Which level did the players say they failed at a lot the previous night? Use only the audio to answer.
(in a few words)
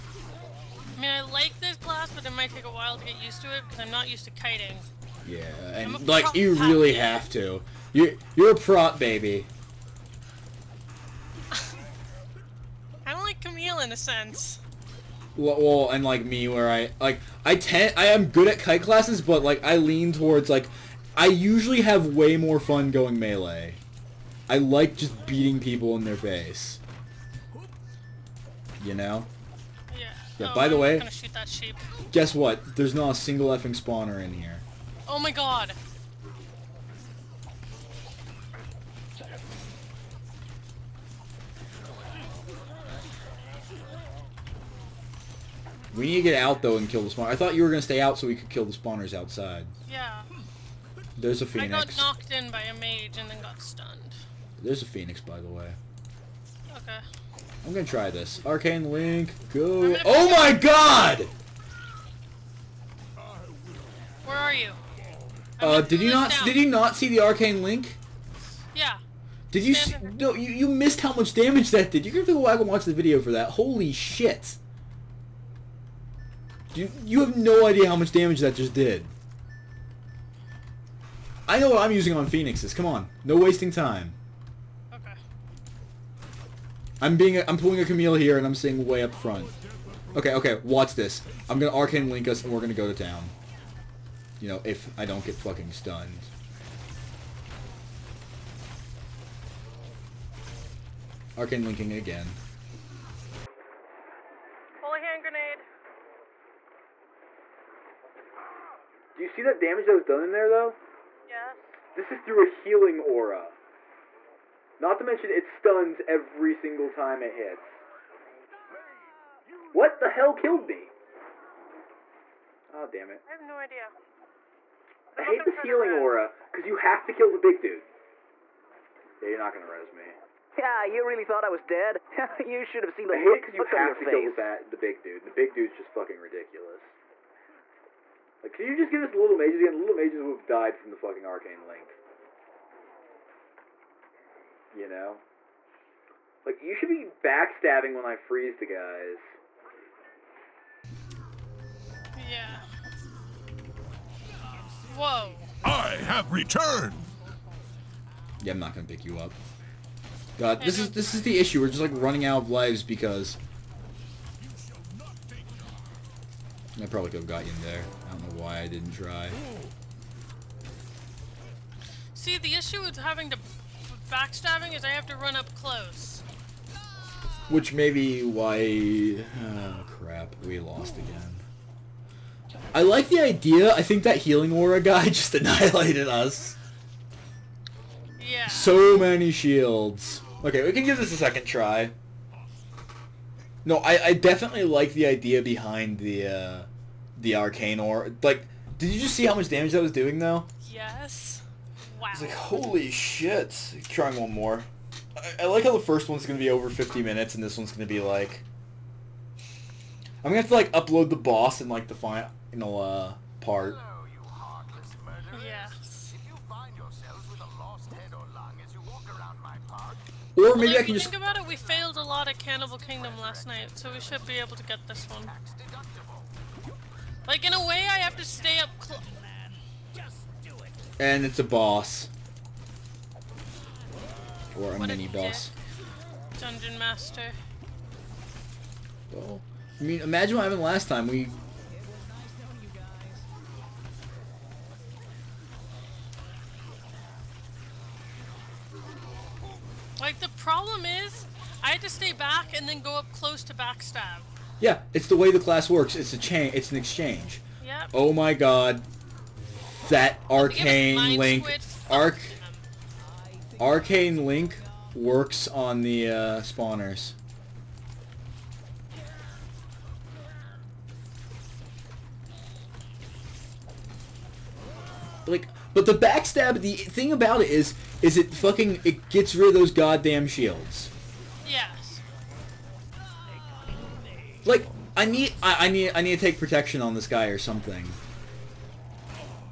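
Cannibal Kingdom.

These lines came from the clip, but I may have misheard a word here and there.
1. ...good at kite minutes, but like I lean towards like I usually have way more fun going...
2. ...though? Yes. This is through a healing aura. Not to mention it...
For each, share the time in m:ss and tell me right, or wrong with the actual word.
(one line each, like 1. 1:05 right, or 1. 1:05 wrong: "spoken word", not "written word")
1. 0:18 wrong: "classes", not "minutes"
2. 1:50 right.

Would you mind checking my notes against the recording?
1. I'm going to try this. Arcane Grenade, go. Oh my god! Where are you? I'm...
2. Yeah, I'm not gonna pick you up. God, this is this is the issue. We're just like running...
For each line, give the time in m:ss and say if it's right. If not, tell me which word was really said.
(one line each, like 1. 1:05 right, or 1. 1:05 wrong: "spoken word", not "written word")
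1. 0:57 wrong: "Link", not "Grenade"
2. 2:38 right.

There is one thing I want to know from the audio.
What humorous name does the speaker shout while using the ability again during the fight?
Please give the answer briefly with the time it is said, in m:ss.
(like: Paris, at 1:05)
Holy Hand Grenade, at 1:44.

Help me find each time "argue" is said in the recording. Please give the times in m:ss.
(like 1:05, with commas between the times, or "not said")
not said.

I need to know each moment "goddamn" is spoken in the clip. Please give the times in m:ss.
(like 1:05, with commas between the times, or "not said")
4:39.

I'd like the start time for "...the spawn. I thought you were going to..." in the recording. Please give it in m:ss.
0:47.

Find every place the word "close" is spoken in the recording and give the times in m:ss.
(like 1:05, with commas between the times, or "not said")
2:55, 3:48, 4:13.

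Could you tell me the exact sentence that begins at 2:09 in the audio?
Yeah, you're not going to res me.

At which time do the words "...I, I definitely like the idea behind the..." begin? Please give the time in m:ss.
3:13.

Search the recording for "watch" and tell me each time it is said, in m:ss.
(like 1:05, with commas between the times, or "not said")
1:12, 1:30.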